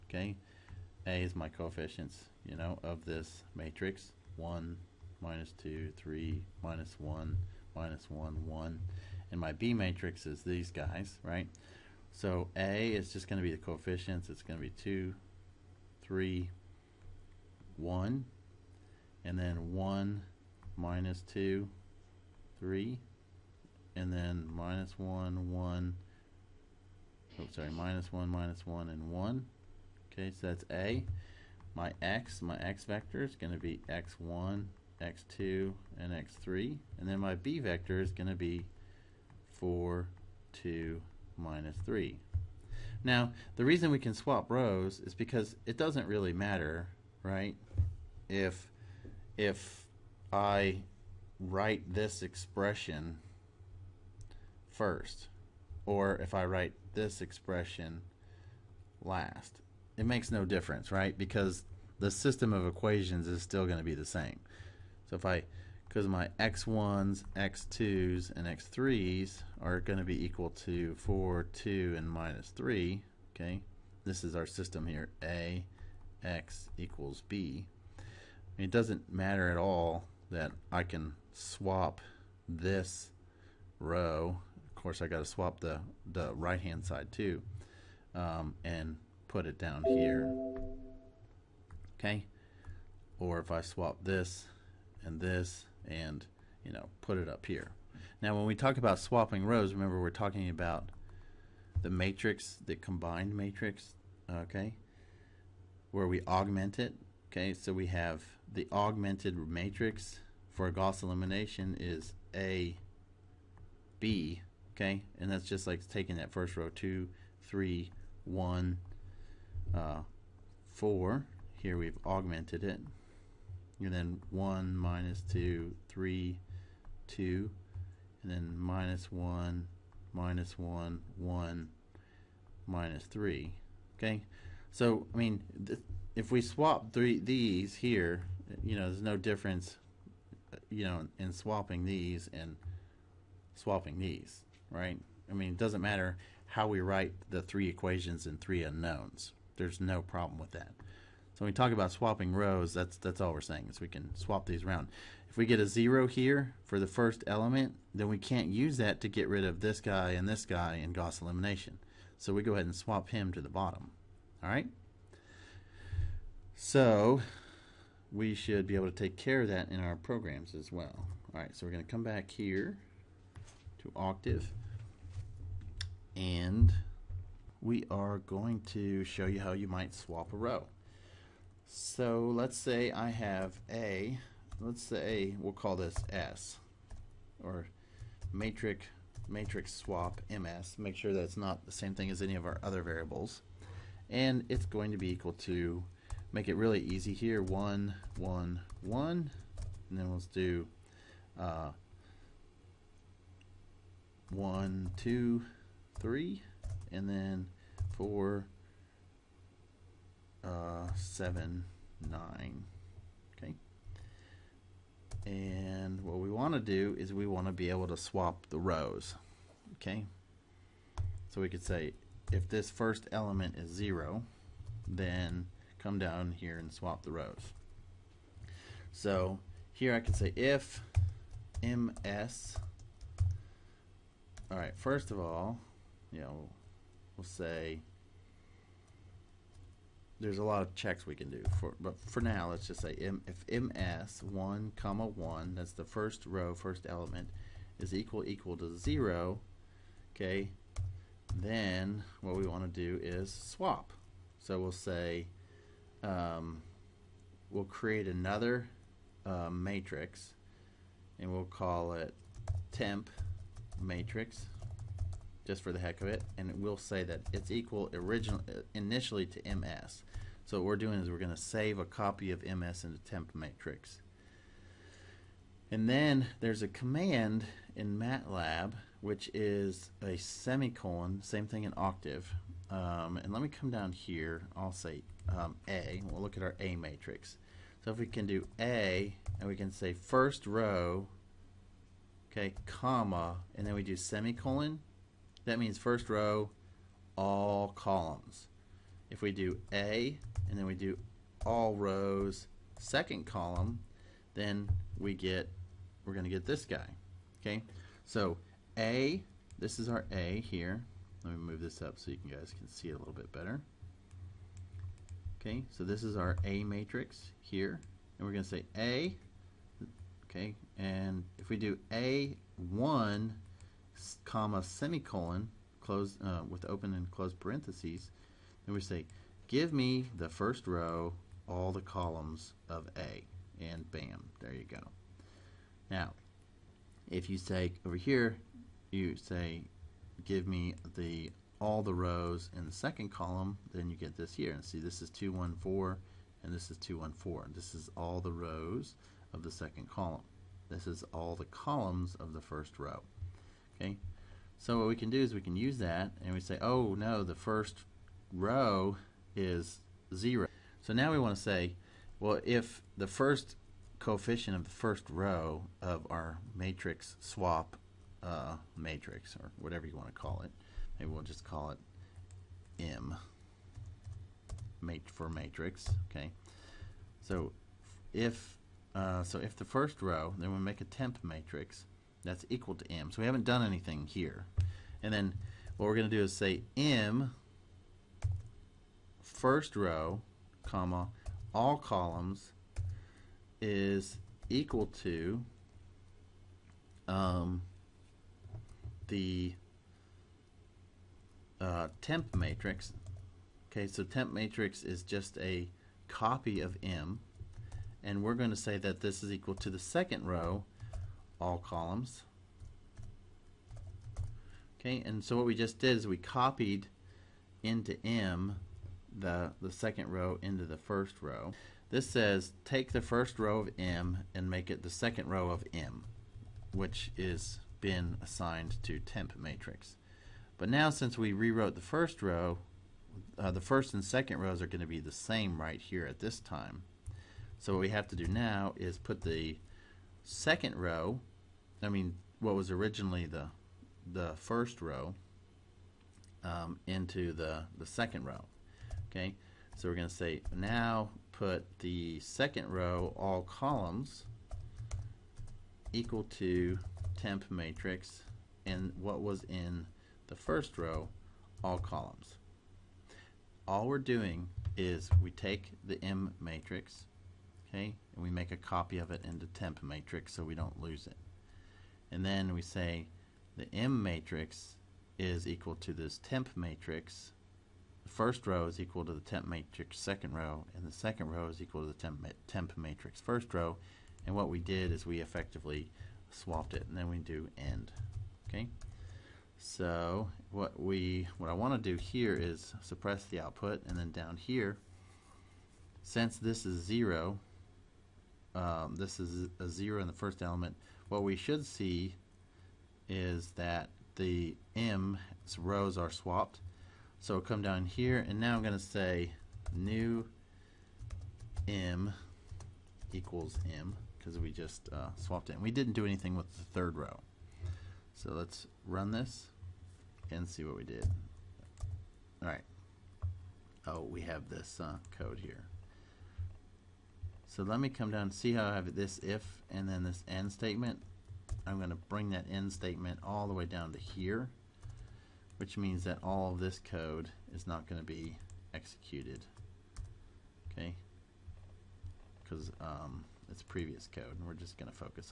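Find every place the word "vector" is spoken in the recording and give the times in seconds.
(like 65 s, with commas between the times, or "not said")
32 s, 37 s.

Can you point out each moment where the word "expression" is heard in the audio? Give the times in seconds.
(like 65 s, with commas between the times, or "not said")
52 s, 57 s.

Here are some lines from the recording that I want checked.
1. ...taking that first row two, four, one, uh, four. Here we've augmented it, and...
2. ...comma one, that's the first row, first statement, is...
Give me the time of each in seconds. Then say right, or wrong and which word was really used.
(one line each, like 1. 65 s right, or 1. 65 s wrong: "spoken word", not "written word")
1. 115 s wrong: "three", not "four"
2. 244 s wrong: "element", not "statement".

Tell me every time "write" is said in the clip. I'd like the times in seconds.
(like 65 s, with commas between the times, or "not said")
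51 s, 56 s, 146 s.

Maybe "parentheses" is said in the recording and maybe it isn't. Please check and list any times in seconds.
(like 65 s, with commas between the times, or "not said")
327 s.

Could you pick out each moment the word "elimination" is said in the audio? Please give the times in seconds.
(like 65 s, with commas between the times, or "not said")
111 s, 161 s.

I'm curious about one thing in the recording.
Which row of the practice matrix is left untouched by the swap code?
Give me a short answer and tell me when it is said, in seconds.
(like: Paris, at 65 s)
third row, at 516 s.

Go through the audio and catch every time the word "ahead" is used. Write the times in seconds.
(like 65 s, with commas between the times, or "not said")
162 s.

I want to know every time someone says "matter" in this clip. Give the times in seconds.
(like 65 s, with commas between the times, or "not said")
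46 s, 79 s, 145 s.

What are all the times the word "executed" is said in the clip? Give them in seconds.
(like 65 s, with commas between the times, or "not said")
538 s.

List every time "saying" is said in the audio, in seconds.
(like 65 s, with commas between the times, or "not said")
153 s.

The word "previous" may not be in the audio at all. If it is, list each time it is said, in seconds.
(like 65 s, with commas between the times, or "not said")
543 s.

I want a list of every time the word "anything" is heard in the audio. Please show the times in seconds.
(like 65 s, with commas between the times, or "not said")
383 s, 516 s.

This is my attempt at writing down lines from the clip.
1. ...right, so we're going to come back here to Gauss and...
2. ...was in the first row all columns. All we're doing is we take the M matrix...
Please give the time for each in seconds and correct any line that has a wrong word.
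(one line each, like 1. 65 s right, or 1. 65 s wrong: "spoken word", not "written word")
1. 171 s wrong: "Octave", not "Gauss"
2. 459 s right.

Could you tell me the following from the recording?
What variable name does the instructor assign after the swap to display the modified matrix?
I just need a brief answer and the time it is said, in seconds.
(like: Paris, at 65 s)
new m, at 509 s.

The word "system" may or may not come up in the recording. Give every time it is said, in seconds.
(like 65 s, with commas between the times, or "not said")
62 s, 74 s.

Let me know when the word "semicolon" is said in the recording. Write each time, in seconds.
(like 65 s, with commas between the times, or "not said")
280 s, 293 s, 324 s.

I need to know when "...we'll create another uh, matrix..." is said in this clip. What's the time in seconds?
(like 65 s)
257 s.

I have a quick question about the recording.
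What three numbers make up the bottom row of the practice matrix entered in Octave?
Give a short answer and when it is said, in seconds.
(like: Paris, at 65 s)
4, 7, 9, at 207 s.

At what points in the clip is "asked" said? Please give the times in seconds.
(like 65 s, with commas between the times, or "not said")
not said.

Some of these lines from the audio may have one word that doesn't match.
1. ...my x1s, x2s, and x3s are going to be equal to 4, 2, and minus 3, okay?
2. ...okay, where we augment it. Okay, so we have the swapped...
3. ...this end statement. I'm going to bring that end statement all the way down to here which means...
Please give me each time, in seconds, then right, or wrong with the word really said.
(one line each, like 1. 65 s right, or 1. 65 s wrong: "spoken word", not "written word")
1. 66 s right
2. 104 s wrong: "augmented", not "swapped"
3. 530 s right.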